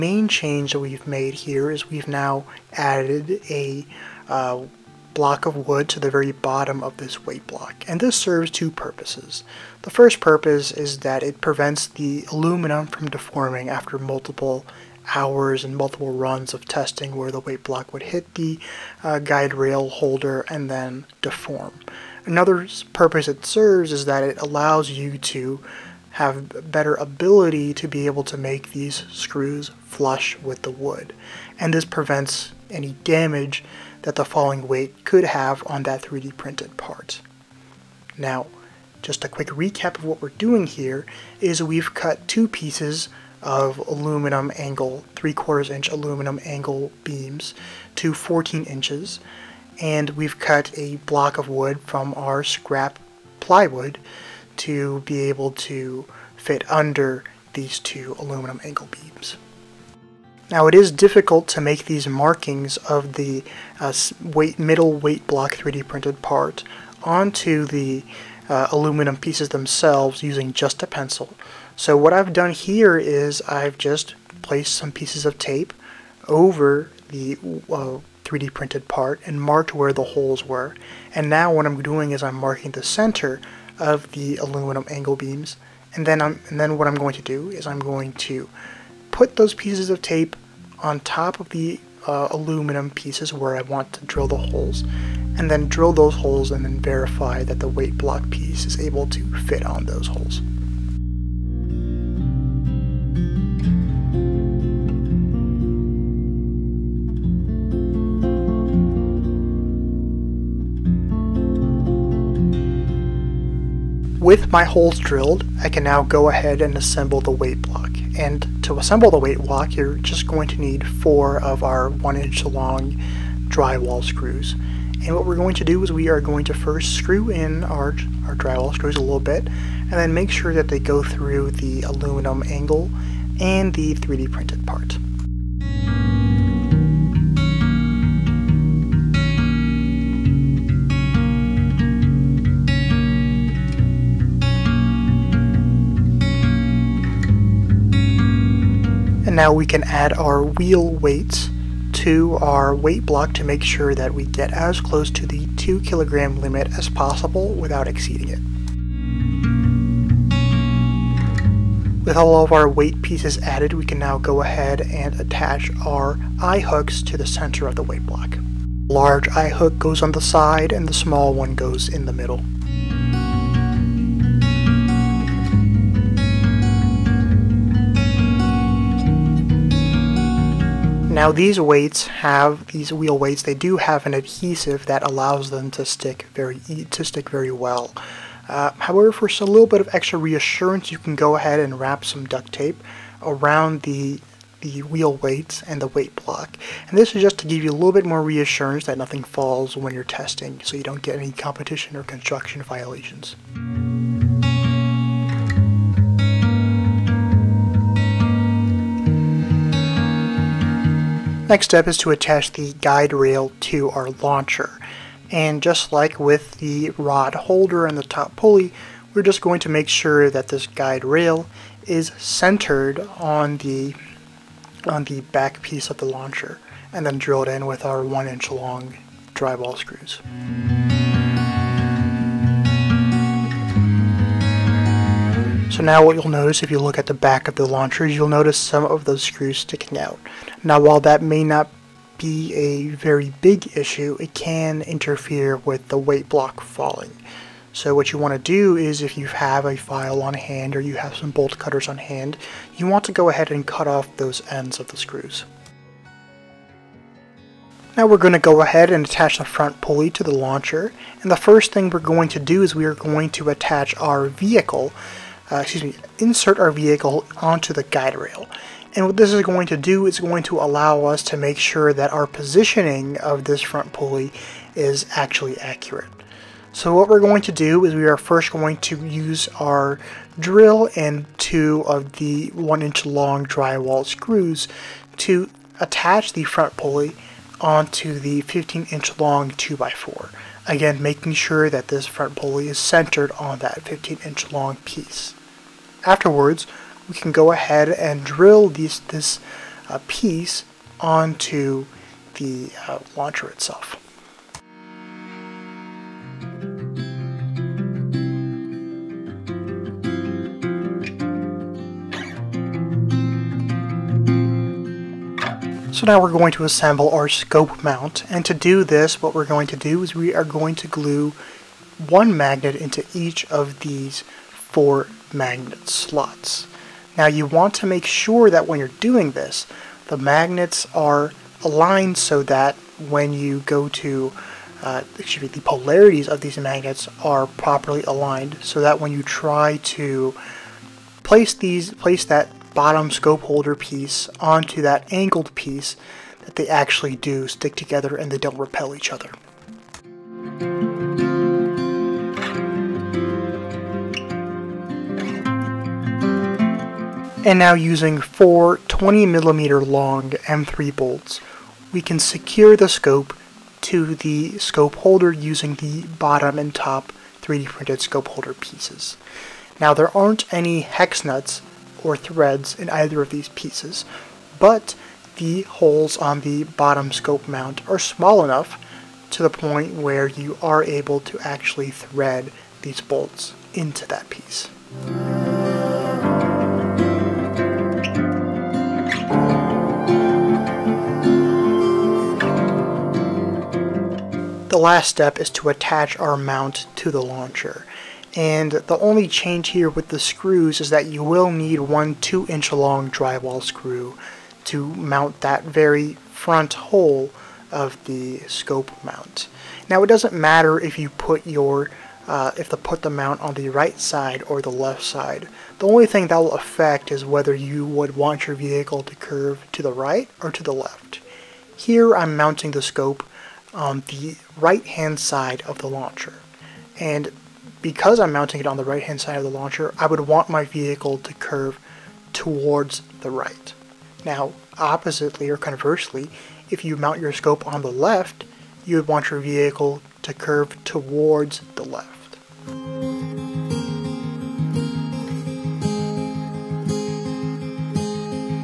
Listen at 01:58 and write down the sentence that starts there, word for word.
And to assemble the weight block, you're just going to need four of our one inch long drywall screws.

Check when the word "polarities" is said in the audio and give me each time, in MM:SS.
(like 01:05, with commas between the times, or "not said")
05:35.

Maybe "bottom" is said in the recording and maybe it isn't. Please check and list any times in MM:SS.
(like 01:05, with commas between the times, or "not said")
00:06, 05:42, 06:06, 06:16.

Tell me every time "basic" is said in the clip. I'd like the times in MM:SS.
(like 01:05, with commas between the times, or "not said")
not said.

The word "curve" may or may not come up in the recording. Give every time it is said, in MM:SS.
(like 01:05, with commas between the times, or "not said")
06:59, 07:11, 07:20.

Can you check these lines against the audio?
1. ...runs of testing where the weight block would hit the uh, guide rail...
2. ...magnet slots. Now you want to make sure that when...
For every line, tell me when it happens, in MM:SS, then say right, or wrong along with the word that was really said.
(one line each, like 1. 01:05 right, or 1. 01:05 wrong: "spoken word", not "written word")
1. 00:16 right
2. 05:25 right.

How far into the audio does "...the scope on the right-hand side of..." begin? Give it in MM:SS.
07:02.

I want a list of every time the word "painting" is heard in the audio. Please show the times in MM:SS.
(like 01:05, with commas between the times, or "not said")
not said.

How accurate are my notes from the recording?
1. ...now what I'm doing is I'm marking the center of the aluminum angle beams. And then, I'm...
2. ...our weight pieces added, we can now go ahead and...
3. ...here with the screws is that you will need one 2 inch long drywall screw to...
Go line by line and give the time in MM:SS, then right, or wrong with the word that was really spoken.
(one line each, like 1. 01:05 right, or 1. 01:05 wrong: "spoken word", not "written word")
1. 01:21 right
2. 02:42 right
3. 06:39 right.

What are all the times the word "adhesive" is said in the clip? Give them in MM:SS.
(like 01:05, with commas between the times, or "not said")
03:04.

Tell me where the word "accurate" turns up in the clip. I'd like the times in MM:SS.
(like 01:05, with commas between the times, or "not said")
04:35.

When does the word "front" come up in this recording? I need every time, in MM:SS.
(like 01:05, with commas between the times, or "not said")
04:19, 04:33, 04:46, 04:52, 06:46.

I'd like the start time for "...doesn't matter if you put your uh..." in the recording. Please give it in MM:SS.
06:50.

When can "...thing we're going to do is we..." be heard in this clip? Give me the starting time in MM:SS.
04:21.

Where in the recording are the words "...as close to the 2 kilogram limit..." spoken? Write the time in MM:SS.
02:34.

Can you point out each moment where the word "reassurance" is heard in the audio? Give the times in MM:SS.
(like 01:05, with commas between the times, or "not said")
03:10, 03:18.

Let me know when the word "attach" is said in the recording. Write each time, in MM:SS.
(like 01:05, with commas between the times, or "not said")
02:45, 03:32, 04:19, 04:23, 04:45, 06:35.